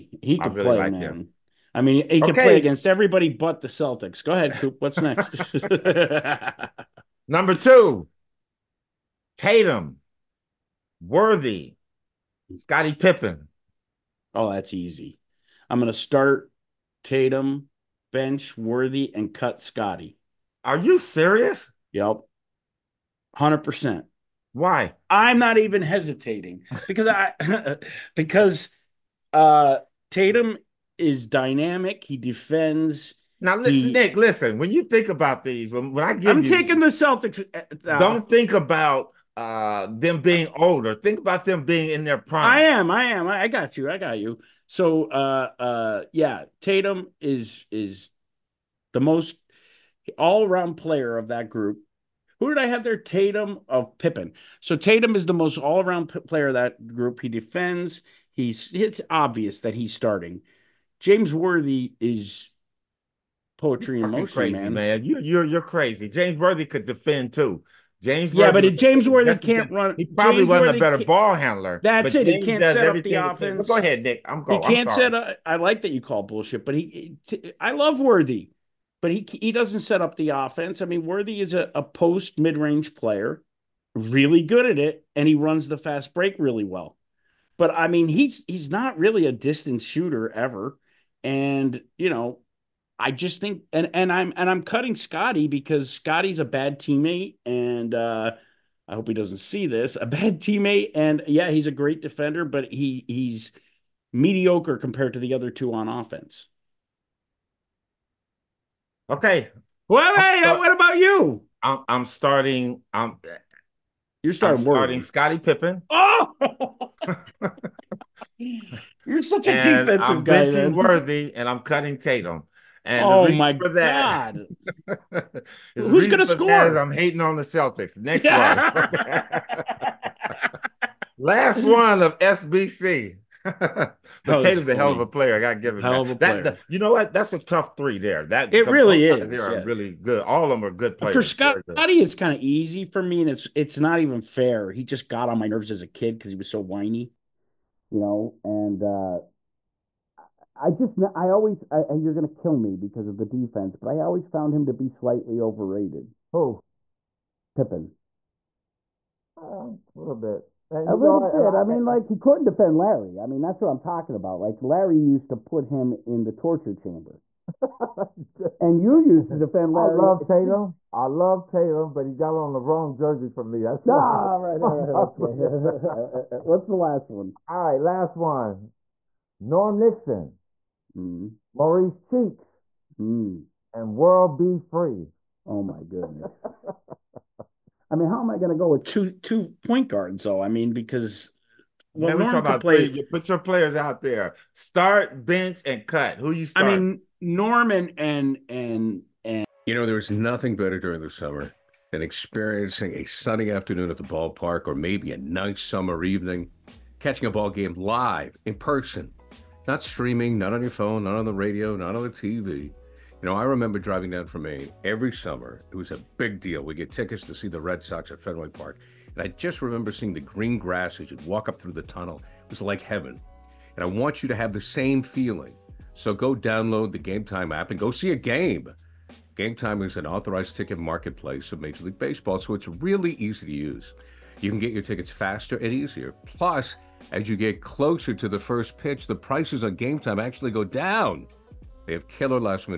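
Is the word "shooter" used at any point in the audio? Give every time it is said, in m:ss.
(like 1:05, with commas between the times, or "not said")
1:29.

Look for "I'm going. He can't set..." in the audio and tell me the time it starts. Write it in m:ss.
1:14.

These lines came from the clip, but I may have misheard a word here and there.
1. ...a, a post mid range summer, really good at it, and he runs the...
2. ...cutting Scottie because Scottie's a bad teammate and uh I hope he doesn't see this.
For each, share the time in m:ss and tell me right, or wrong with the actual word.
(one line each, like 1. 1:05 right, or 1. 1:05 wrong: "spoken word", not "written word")
1. 1:21 wrong: "player", not "summer"
2. 1:34 right.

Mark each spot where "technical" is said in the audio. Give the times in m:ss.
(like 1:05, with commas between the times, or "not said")
not said.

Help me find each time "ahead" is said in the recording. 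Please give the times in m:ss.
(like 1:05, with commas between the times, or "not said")
0:04, 1:13.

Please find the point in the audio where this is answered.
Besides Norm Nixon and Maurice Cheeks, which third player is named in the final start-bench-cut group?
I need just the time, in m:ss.
3:03.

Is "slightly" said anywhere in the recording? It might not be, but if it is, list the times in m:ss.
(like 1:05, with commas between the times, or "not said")
2:34.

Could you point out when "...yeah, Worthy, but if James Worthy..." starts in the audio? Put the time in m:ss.
1:08.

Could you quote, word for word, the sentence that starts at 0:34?
When you think about these, when, when I give, I'm you, taking the Celtics.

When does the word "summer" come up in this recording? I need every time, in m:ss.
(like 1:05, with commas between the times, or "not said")
3:21, 3:25, 3:35.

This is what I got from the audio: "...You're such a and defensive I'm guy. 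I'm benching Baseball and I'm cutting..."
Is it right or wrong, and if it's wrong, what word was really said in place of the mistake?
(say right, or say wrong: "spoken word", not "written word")
wrong: "Worthy", not "Baseball".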